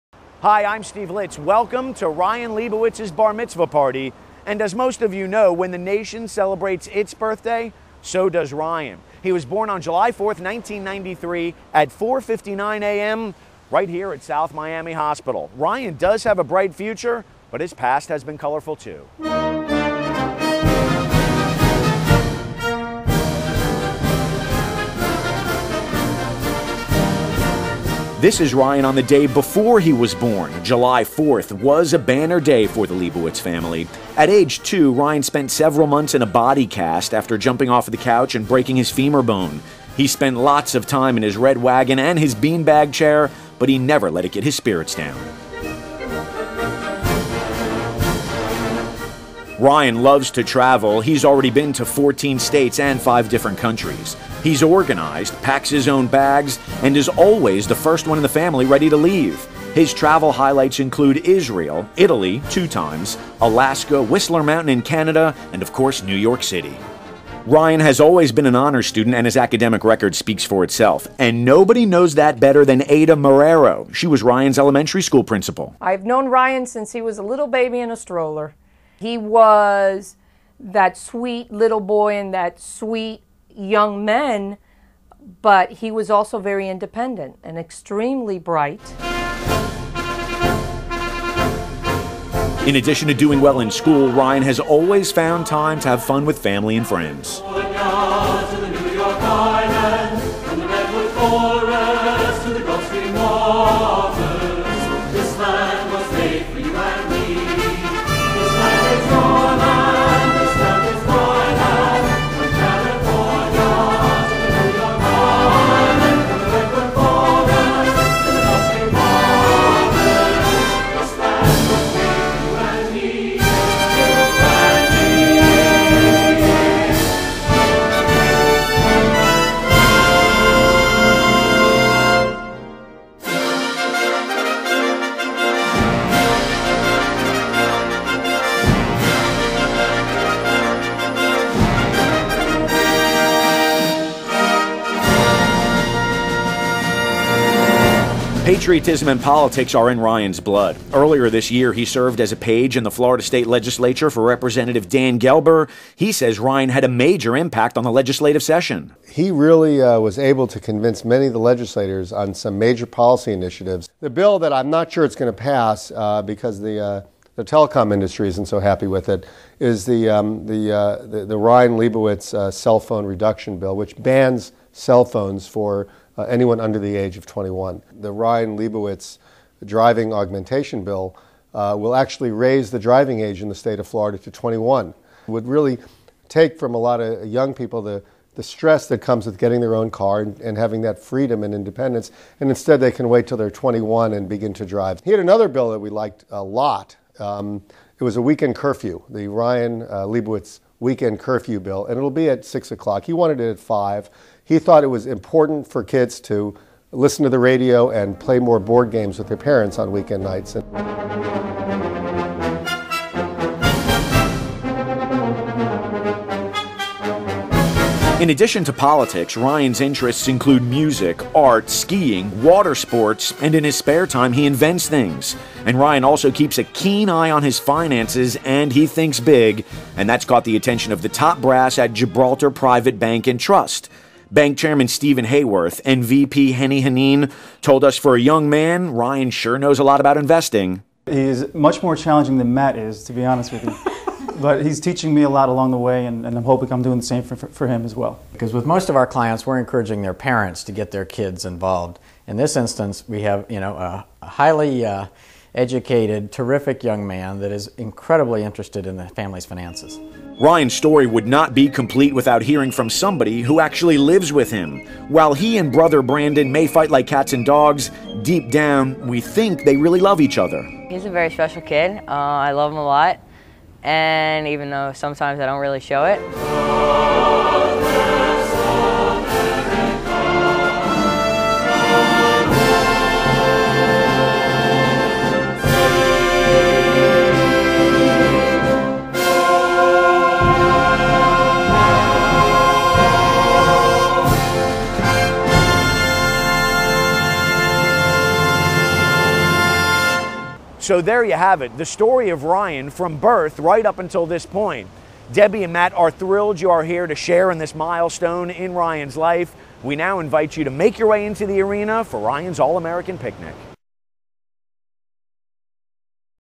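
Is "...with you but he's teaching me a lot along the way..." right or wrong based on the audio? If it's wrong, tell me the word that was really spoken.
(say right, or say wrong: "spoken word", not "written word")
right.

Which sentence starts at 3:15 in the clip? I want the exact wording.
He had another bill that we liked a lot.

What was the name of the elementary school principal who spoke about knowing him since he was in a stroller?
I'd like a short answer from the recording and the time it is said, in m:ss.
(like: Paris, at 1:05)
Ada Marrero, at 1:12.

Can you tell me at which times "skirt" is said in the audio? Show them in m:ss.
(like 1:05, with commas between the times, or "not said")
not said.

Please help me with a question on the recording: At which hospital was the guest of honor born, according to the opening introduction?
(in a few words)
South Miami Hospital.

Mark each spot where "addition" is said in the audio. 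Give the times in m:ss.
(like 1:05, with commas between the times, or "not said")
1:32, 3:38.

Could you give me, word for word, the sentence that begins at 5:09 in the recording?
We now invite you to make your way into the arena for Ryan's All American Picnic.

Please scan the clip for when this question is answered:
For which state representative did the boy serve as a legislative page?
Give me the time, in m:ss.
2:34.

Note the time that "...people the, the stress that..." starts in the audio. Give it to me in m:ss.
3:07.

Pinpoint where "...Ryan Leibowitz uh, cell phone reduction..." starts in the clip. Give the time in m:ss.
2:51.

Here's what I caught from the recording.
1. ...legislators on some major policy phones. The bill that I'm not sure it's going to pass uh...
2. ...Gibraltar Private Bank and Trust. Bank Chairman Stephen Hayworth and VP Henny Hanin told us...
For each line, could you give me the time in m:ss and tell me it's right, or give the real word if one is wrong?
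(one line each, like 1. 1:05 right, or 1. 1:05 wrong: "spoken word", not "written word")
1. 2:41 wrong: "initiatives", not "phones"
2. 3:51 right.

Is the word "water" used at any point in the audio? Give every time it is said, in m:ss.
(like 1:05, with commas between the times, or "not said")
3:42.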